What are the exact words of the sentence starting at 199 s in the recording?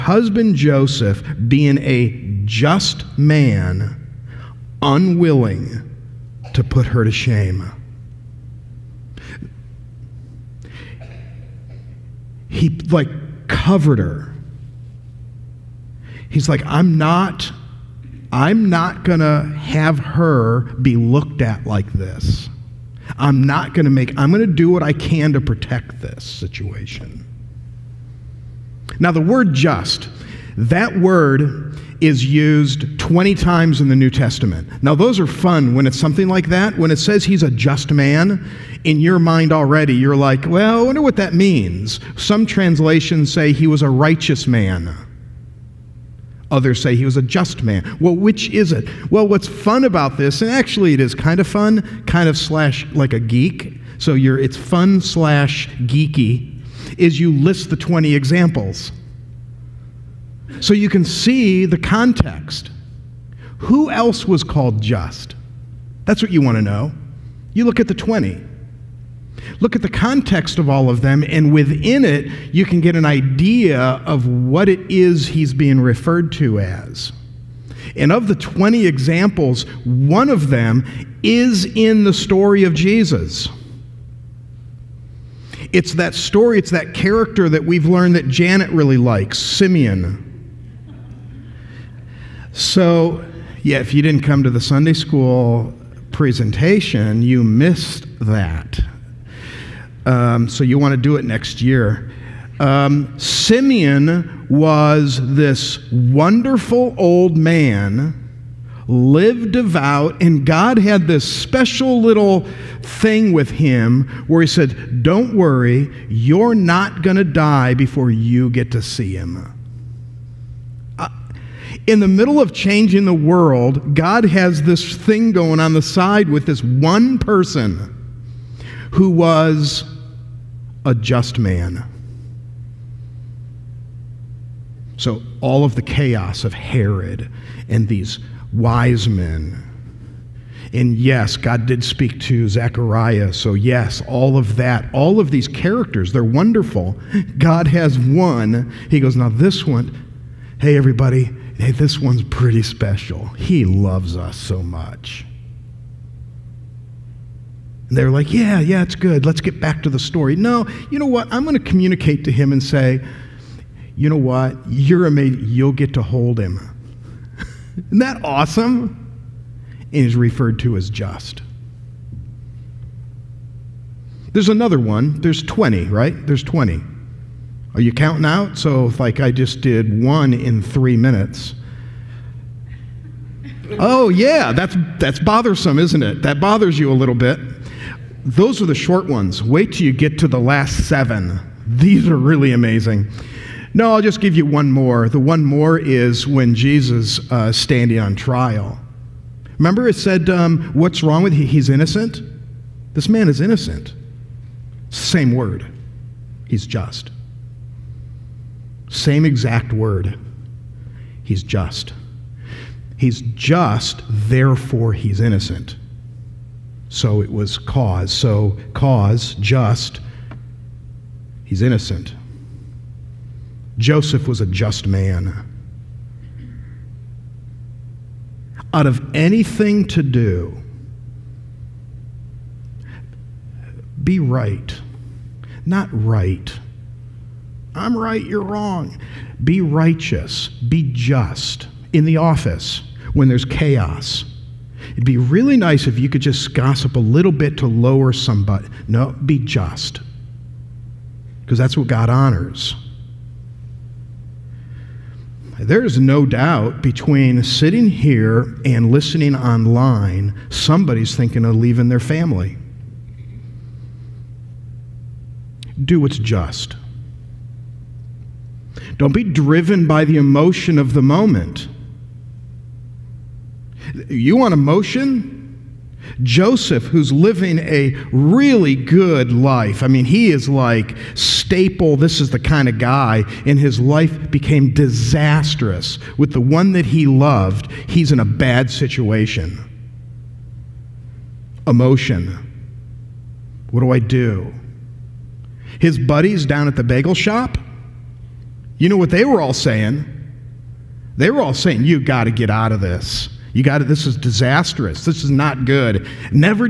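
Remember, it said, um, "What's wrong with he?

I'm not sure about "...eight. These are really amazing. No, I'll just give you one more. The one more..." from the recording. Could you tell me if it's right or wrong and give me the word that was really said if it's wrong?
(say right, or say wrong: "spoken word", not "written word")
wrong: "seven", not "eight".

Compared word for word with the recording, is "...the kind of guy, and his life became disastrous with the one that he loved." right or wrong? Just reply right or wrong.
right.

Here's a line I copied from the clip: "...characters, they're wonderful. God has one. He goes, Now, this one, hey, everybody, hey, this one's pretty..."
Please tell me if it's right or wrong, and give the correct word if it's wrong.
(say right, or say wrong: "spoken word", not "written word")
right.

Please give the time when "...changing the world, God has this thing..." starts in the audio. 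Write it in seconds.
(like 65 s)
122 s.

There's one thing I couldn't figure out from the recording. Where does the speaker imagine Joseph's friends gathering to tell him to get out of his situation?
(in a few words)
the bagel shop.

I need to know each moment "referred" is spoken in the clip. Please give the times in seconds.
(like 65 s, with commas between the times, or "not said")
75 s, 170 s.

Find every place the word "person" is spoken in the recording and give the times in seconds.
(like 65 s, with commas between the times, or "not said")
127 s.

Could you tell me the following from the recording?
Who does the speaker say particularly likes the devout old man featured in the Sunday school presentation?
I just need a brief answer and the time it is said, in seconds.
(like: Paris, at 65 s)
Janet, at 88 s.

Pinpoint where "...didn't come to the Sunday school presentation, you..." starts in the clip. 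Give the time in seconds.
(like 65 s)
94 s.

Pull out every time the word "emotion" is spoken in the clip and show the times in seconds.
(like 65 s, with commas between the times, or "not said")
270 s, 274 s, 291 s.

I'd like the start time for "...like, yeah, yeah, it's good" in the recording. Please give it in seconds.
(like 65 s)
158 s.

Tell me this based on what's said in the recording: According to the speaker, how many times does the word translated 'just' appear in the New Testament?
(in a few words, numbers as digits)
20.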